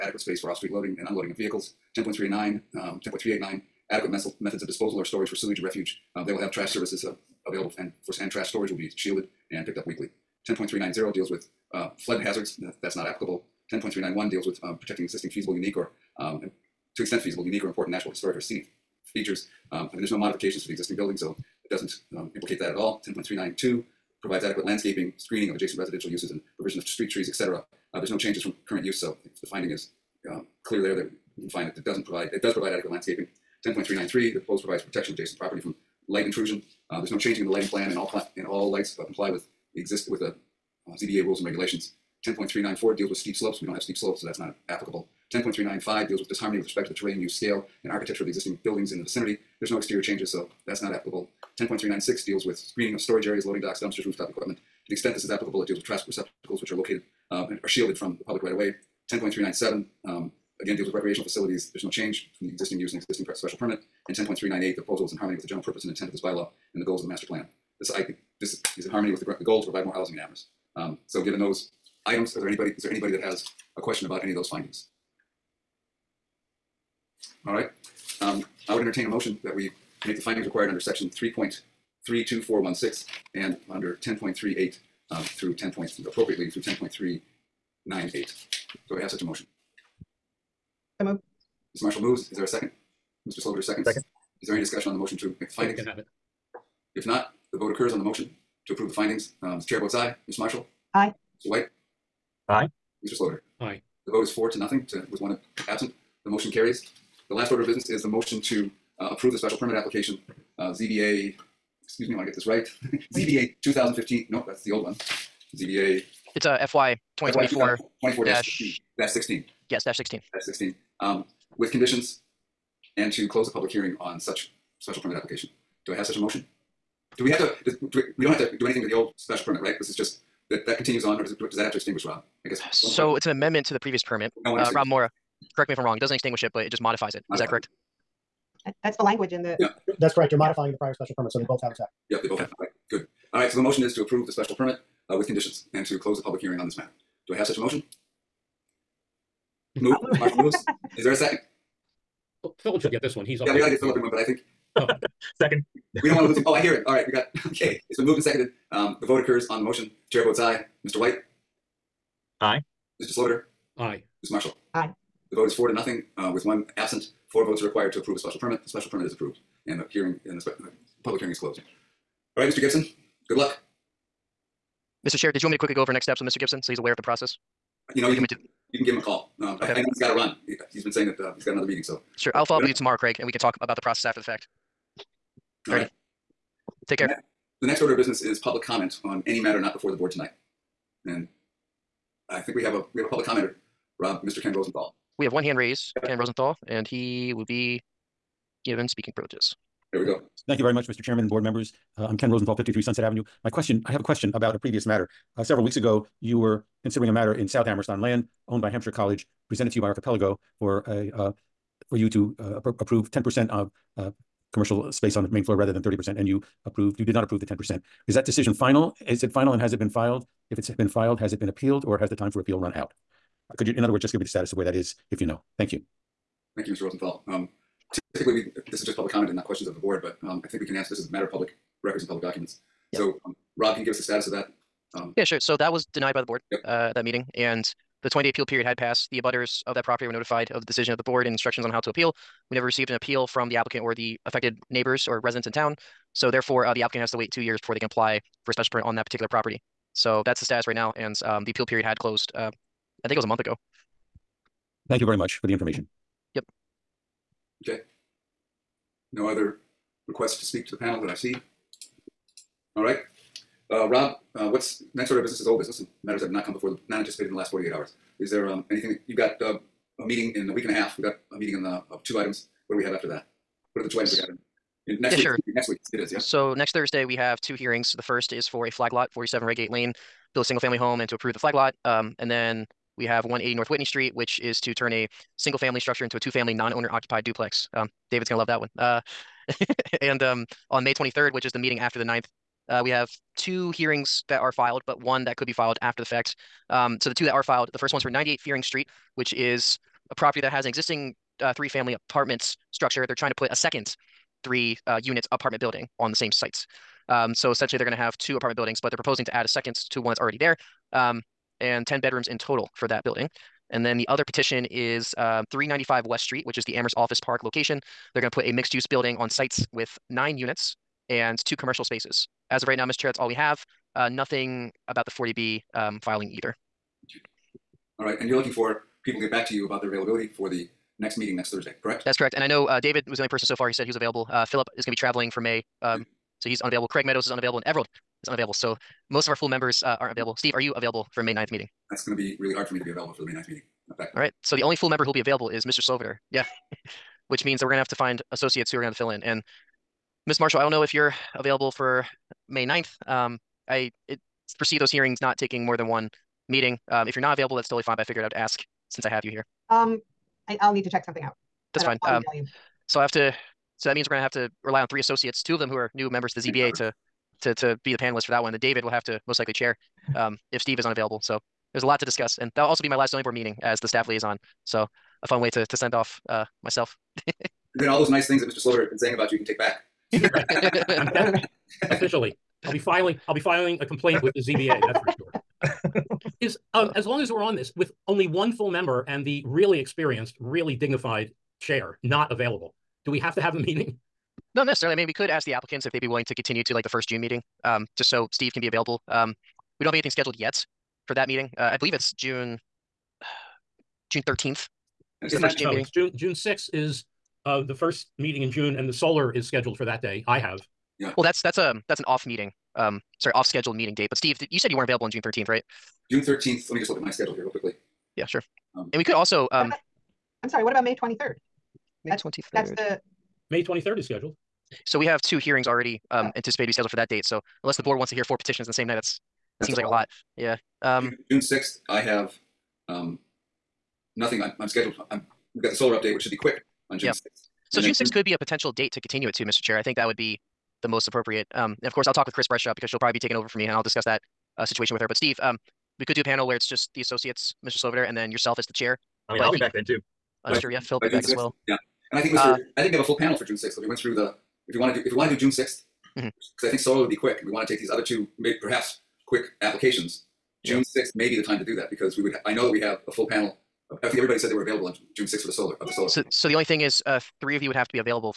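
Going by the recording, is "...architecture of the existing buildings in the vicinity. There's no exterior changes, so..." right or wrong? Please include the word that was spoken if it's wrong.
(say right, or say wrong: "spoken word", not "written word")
right.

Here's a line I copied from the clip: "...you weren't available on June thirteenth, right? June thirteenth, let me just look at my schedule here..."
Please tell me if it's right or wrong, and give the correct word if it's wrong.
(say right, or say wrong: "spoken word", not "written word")
right.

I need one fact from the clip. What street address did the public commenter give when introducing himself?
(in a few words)
53 Sunset Avenue.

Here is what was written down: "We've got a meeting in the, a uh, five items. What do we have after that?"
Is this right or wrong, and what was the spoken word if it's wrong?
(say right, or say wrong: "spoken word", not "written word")
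wrong: "two", not "five".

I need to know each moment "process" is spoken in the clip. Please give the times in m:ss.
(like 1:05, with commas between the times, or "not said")
2:57, 3:03.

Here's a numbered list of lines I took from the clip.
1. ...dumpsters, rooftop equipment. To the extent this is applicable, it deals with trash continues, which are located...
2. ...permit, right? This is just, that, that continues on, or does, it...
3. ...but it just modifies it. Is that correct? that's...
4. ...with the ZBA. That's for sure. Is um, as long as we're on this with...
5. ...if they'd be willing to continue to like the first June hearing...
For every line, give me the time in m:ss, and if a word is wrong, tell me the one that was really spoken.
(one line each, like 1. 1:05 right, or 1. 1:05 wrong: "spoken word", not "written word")
1. 0:53 wrong: "receptacles", not "continues"
2. 2:09 right
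3. 2:16 right
4. 6:24 right
5. 6:35 wrong: "meeting", not "hearing".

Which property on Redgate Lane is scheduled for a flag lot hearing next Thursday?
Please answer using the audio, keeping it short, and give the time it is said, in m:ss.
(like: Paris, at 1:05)
47 Redgate Lane, at 4:39.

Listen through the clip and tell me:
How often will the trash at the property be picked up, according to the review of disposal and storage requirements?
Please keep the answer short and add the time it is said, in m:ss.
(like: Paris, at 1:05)
Weekly, at 0:09.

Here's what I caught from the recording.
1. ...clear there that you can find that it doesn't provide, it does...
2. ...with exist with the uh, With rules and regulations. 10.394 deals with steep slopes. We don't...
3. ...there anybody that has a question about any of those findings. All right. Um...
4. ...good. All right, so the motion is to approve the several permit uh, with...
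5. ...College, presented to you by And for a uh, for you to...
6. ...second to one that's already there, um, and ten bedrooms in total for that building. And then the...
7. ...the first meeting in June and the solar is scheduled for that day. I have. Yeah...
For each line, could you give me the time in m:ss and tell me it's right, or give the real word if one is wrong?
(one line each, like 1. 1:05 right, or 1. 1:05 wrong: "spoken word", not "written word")
1. 0:30 right
2. 0:39 wrong: "ZBA", not "With"
3. 1:12 right
4. 2:22 wrong: "special", not "several"
5. 3:28 wrong: "Archipelago", not "And"
6. 5:09 right
7. 6:47 right.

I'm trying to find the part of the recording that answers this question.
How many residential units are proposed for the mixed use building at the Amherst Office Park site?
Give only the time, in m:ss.
5:20.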